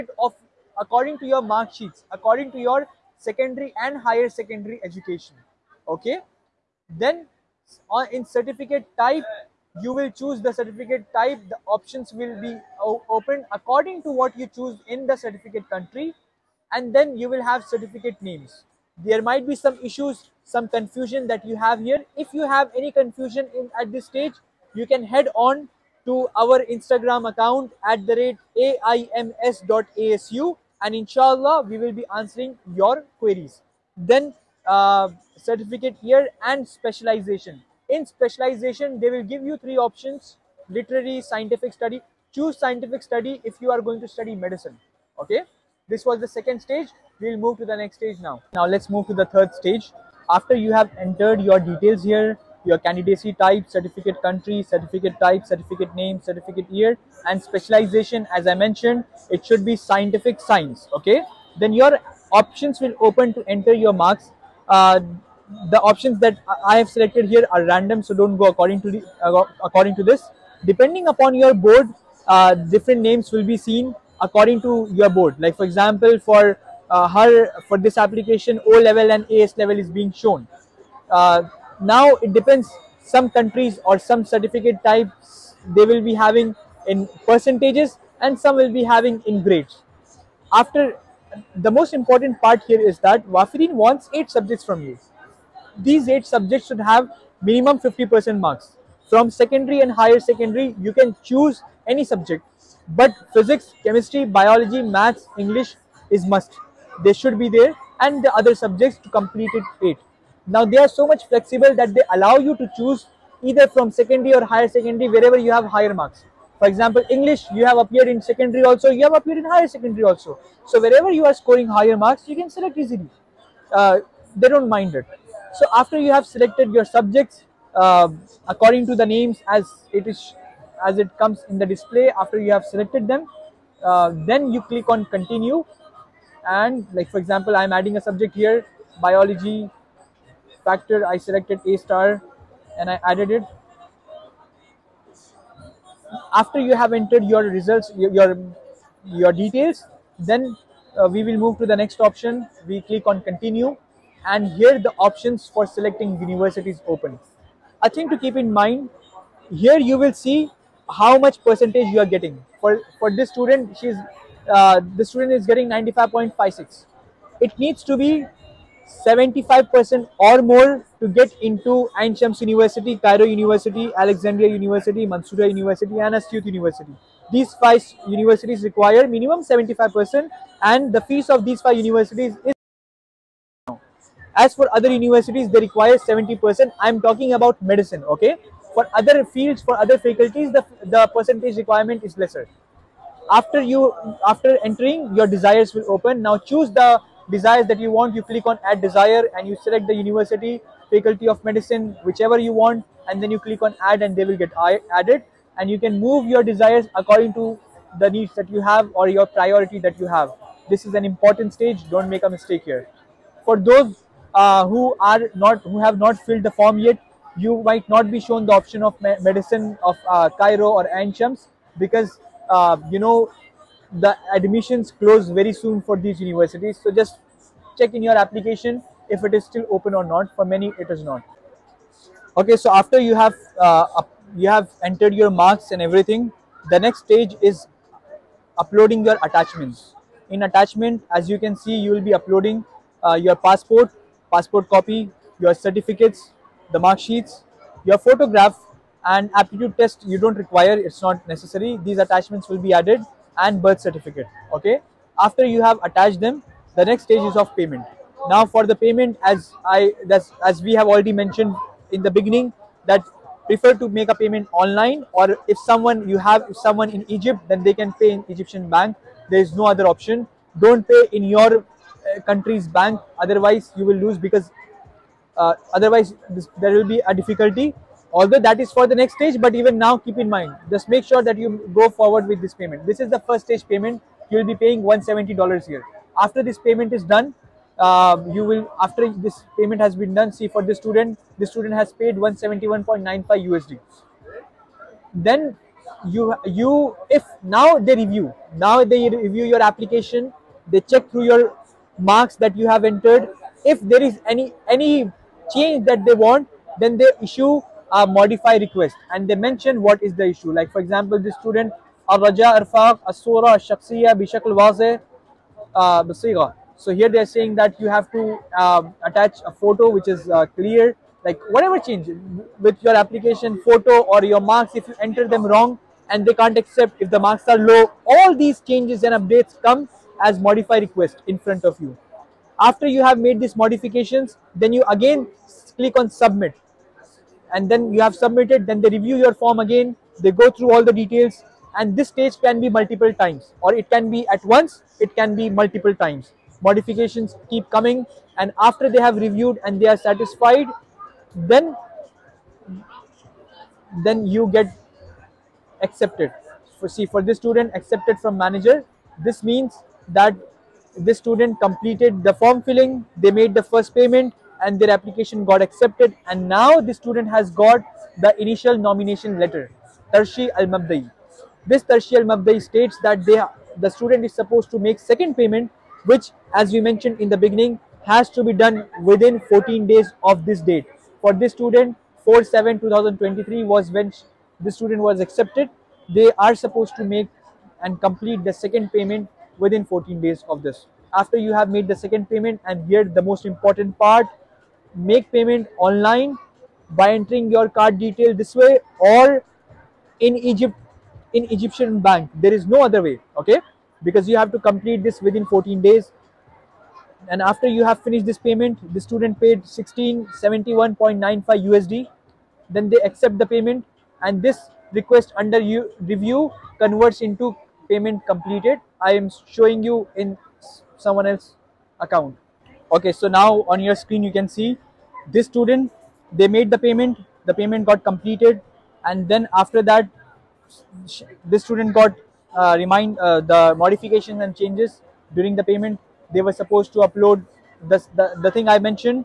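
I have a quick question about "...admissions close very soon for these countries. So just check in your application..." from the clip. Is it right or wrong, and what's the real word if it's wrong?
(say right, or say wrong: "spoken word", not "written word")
wrong: "universities", not "countries".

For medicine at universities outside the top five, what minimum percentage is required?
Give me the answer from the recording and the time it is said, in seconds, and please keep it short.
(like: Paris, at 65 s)
70%, at 185 s.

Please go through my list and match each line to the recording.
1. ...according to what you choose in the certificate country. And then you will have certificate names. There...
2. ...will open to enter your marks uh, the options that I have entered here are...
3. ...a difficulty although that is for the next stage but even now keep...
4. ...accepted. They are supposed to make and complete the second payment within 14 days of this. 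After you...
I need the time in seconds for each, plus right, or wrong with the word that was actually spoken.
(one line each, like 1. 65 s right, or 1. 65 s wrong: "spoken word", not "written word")
1. 13 s right
2. 62 s wrong: "selected", not "entered"
3. 277 s right
4. 385 s right.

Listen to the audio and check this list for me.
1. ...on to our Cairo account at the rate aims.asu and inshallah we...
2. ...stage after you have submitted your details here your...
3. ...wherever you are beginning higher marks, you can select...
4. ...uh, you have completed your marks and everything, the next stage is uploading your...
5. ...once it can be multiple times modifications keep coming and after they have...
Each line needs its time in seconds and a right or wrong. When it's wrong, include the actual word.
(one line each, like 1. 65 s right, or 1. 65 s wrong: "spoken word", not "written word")
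1. 25 s wrong: "Instagram", not "Cairo"
2. 49 s wrong: "entered", not "submitted"
3. 120 s wrong: "scoring", not "beginning"
4. 233 s wrong: "entered", not "completed"
5. 344 s right.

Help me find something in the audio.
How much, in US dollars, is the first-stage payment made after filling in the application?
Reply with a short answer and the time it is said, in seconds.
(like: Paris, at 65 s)
170 dollars, at 284 s.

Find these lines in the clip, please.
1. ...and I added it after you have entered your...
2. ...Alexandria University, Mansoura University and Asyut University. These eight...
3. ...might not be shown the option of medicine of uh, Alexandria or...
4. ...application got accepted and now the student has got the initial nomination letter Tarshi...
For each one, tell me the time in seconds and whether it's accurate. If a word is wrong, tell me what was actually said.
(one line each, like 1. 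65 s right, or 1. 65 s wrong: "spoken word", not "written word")
1. 142 s right
2. 173 s wrong: "five", not "eight"
3. 217 s wrong: "Cairo", not "Alexandria"
4. 364 s right.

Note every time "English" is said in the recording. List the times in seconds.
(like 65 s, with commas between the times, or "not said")
105 s, 117 s.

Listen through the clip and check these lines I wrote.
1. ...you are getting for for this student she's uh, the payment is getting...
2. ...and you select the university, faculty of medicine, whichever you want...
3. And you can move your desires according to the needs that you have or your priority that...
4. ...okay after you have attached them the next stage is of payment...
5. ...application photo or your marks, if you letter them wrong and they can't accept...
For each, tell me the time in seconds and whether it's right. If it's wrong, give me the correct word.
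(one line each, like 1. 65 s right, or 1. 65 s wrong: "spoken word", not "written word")
1. 161 s wrong: "student", not "payment"
2. 199 s right
3. 205 s right
4. 254 s right
5. 322 s wrong: "enter", not "letter".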